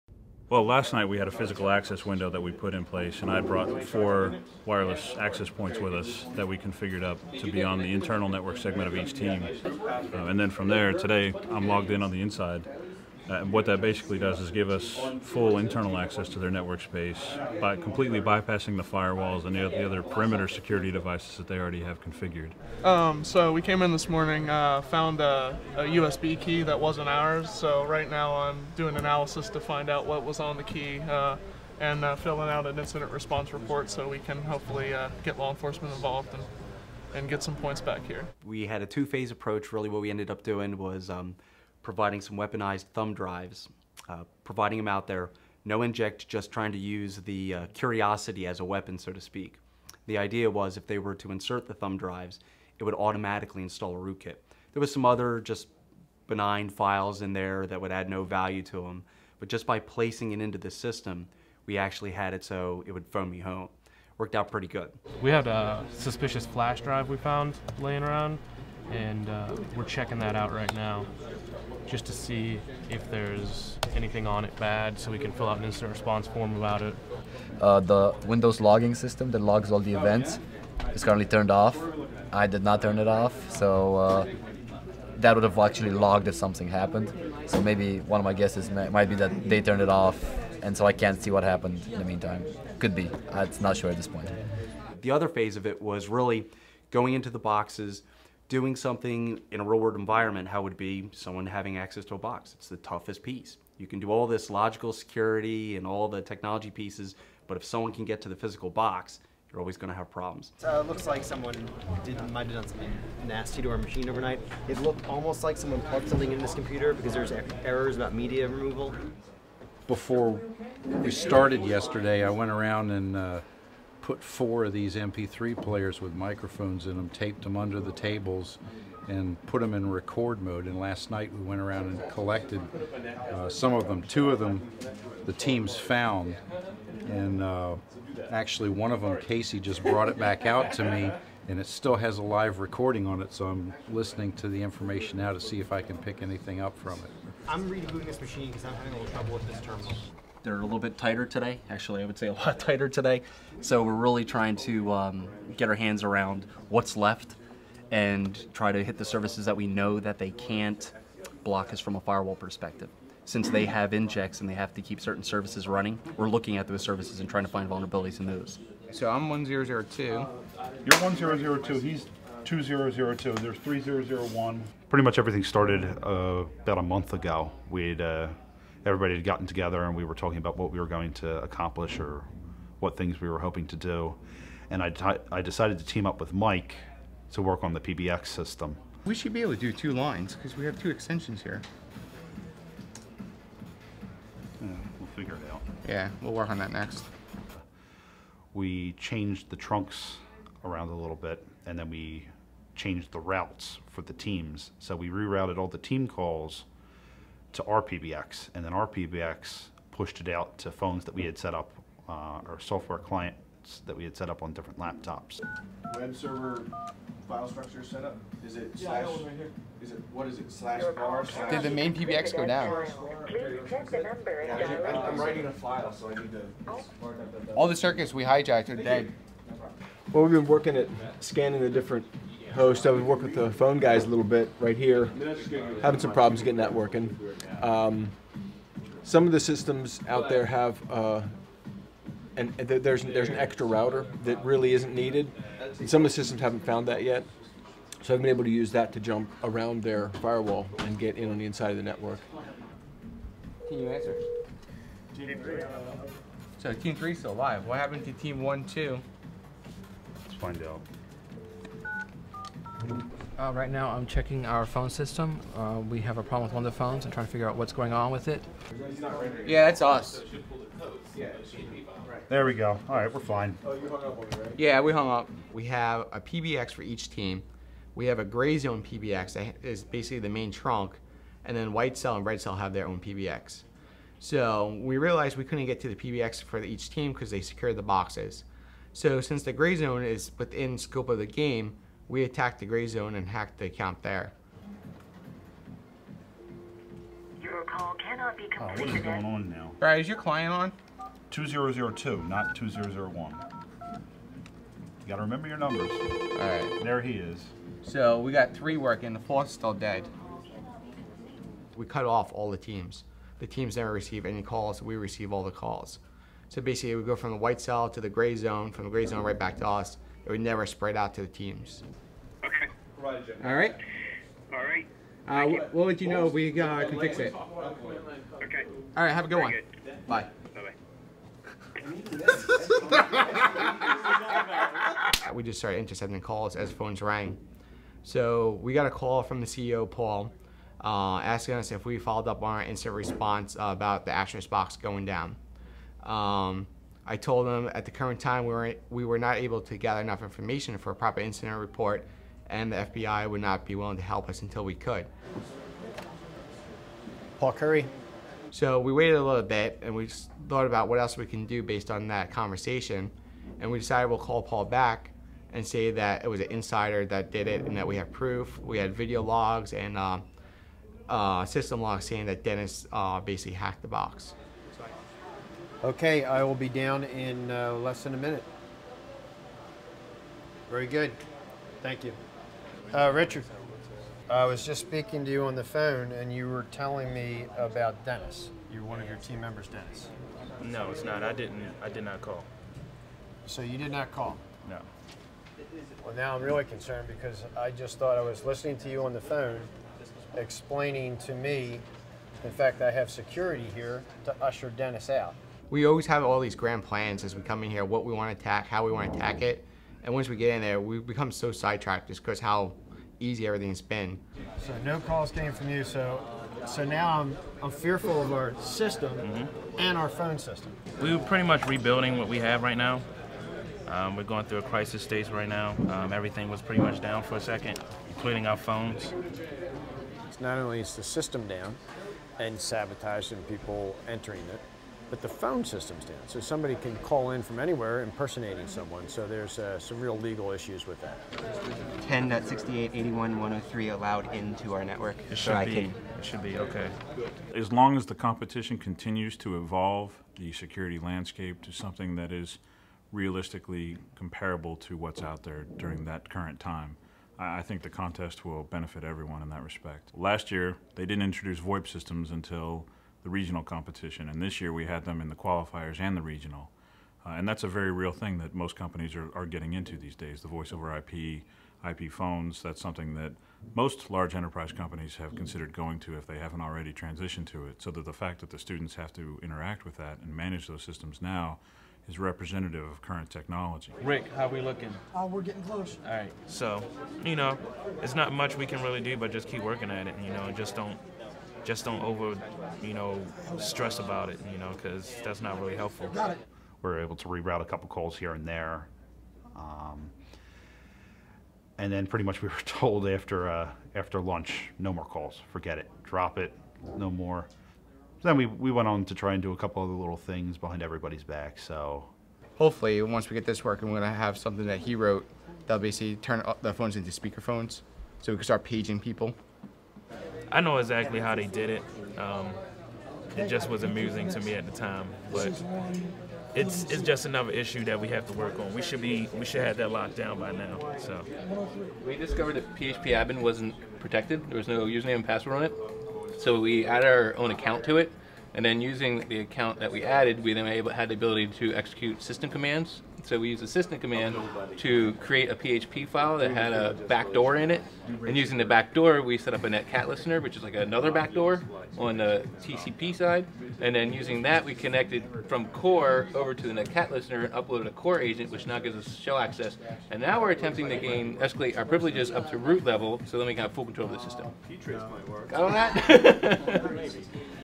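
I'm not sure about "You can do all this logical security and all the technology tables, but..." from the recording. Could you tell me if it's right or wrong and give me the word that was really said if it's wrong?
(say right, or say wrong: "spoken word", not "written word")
wrong: "pieces", not "tables".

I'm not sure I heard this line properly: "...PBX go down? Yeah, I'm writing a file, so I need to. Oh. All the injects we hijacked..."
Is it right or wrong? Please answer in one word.
wrong.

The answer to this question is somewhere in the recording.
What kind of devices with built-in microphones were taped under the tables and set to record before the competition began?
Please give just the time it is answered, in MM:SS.
02:04.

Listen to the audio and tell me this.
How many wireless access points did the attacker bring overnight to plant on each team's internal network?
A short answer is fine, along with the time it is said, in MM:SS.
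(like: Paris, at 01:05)
4, at 00:03.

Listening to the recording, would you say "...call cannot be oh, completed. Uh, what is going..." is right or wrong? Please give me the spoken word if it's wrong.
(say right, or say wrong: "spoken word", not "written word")
right.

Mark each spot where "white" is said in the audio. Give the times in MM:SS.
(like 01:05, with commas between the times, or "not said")
04:41, 05:17.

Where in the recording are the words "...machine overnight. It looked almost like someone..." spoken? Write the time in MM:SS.
01:53.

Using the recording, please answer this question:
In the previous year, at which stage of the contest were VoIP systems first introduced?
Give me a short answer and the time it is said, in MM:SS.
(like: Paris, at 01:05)
regional competition, at 07:43.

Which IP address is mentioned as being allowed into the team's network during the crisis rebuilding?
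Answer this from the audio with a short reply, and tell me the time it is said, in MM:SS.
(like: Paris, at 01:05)
10.68.81.103, at 07:22.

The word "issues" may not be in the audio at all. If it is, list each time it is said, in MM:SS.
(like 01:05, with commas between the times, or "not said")
07:20, 08:47.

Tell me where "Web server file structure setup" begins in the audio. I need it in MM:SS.
03:35.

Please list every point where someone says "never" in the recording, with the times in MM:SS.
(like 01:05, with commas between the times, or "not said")
05:13, 05:20.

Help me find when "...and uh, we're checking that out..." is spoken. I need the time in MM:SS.
01:08.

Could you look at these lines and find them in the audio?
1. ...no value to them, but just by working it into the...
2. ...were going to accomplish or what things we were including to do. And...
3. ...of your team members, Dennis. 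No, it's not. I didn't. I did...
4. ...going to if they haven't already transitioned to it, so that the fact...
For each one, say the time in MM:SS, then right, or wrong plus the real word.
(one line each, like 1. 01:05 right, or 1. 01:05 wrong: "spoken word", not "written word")
1. 00:58 wrong: "placing", not "working"
2. 03:00 wrong: "hoping", not "including"
3. 06:29 right
4. 07:55 right.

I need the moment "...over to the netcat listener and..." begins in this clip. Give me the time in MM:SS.
09:16.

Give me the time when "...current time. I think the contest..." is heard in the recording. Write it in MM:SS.
07:36.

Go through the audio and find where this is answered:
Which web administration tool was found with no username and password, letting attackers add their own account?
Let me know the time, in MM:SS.
08:52.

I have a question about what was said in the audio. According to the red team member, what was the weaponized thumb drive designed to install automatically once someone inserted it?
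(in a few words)
rootkit.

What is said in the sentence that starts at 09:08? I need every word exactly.
And using the backdoor, we set up a netcat listener, which is like another backdoor on the TCP side.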